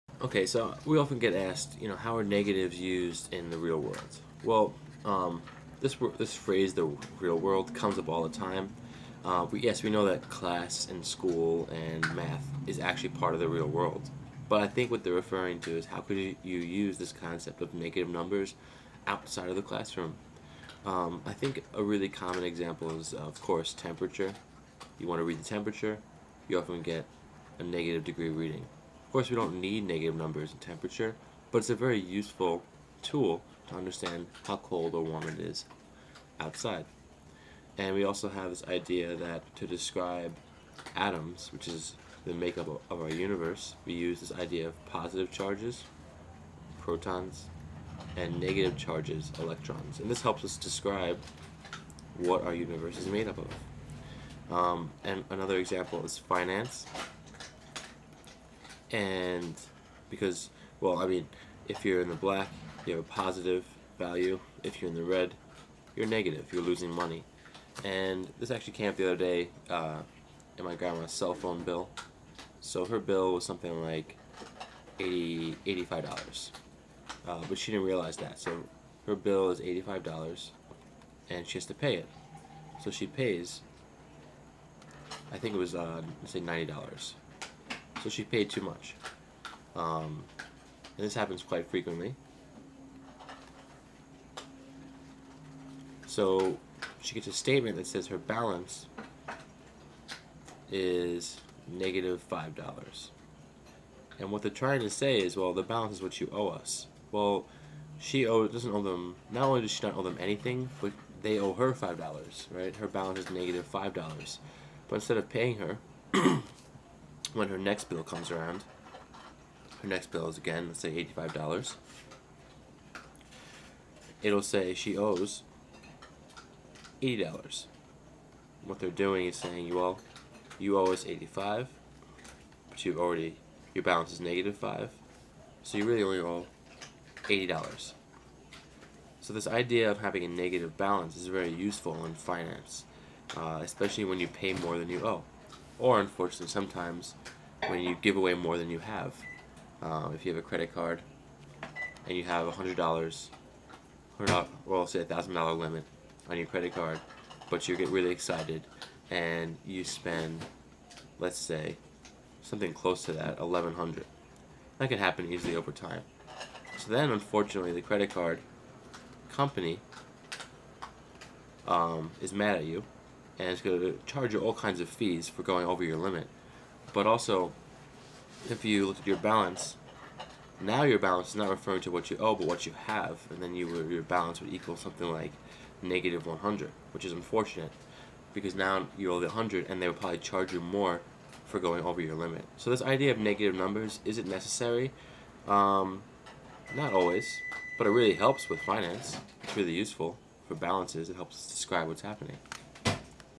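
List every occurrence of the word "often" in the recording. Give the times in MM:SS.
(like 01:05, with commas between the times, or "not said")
00:00, 00:26.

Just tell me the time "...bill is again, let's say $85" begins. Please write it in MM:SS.
02:00.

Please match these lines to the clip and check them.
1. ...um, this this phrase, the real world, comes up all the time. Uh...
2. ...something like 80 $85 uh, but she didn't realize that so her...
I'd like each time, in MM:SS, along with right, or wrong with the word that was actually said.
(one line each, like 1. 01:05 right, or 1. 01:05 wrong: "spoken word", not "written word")
1. 00:05 right
2. 01:13 right.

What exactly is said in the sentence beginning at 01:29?
Um, and this happens quite frequently.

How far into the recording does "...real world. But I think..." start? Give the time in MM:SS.
00:13.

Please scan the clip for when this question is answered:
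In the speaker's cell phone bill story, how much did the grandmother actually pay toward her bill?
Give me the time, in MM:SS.
01:26.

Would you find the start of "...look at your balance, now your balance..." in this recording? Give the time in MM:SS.
02:58.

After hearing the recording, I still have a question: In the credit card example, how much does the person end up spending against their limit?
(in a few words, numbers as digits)
1100.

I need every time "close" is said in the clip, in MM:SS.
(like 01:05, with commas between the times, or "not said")
02:42.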